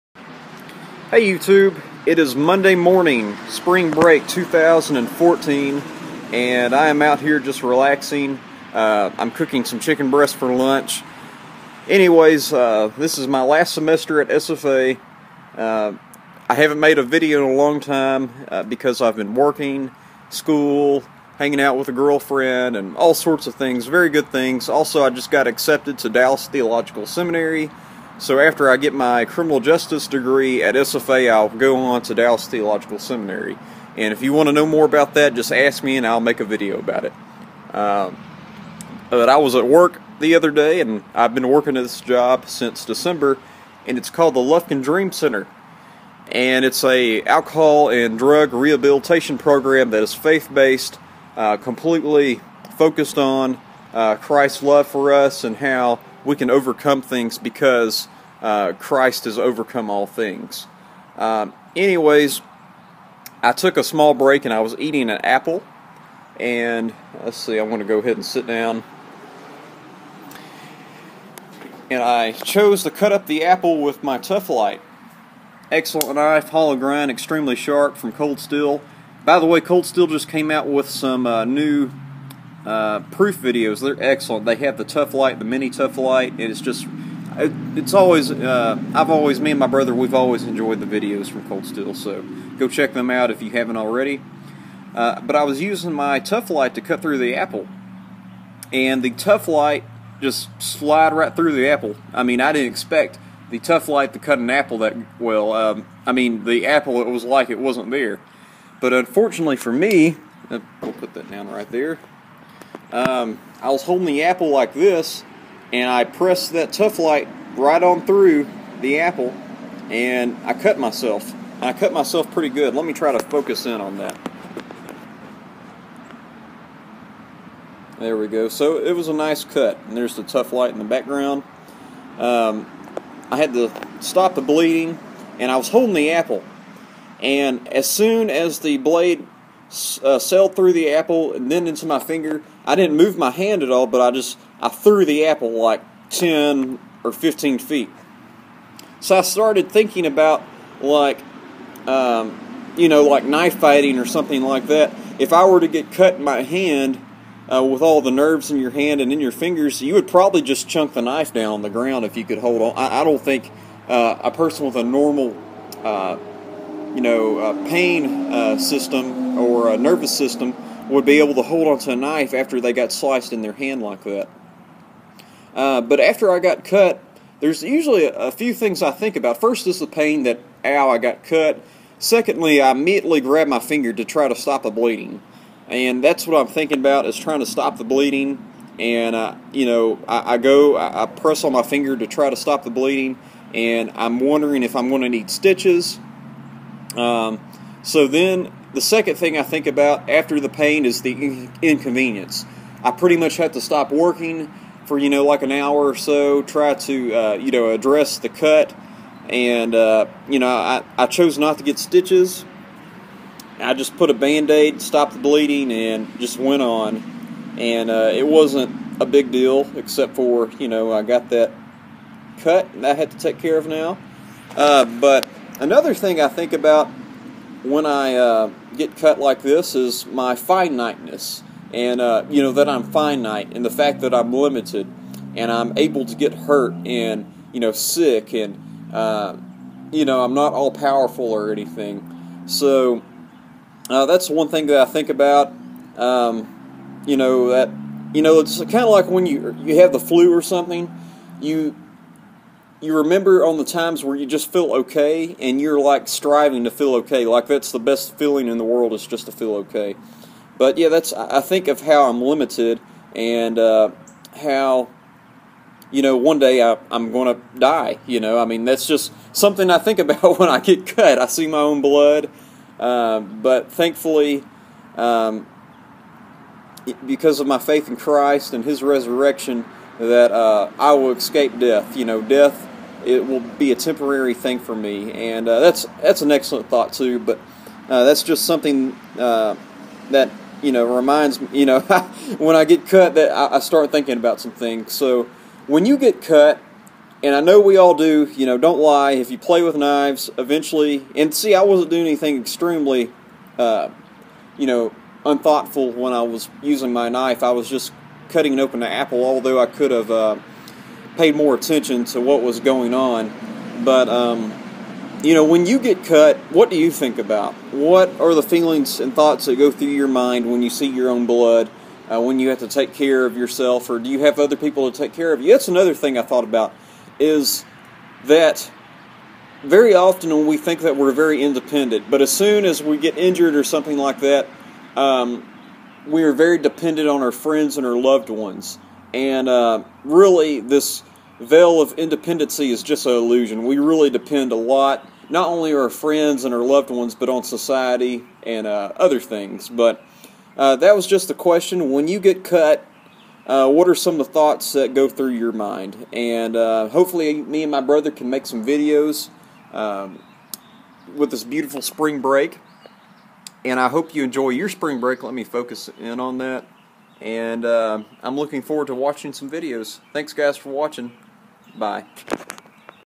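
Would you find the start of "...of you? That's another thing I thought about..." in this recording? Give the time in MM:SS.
05:25.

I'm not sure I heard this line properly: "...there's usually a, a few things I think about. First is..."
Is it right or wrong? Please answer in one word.
right.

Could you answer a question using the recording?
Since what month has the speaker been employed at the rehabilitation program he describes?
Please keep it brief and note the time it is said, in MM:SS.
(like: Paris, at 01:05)
December, at 00:42.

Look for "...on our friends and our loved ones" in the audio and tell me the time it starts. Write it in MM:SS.
05:37.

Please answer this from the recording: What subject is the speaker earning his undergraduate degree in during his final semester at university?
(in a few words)
Criminal justice.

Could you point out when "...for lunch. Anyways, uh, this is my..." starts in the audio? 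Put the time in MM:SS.
00:10.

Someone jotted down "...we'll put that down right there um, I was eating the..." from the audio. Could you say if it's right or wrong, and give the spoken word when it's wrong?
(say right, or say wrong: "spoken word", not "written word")
wrong: "holding", not "eating".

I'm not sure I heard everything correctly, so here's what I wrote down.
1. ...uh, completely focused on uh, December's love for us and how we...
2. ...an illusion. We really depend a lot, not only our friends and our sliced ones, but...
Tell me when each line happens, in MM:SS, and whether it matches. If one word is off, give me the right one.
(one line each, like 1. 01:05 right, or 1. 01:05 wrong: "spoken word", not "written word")
1. 00:51 wrong: "Christ", not "December"
2. 05:43 wrong: "loved", not "sliced".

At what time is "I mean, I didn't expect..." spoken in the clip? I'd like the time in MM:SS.
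01:42.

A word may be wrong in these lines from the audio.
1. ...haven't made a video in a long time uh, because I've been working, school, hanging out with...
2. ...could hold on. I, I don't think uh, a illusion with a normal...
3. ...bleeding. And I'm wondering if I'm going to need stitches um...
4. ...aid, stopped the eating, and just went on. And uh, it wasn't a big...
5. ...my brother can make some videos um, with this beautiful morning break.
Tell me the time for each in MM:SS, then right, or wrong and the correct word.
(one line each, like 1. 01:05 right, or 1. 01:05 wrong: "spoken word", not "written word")
1. 00:16 right
2. 02:42 wrong: "person", not "illusion"
3. 03:12 right
4. 03:34 wrong: "bleeding", not "eating"
5. 05:57 wrong: "spring", not "morning".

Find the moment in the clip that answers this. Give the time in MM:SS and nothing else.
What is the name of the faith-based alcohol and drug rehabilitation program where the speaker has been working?
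00:44.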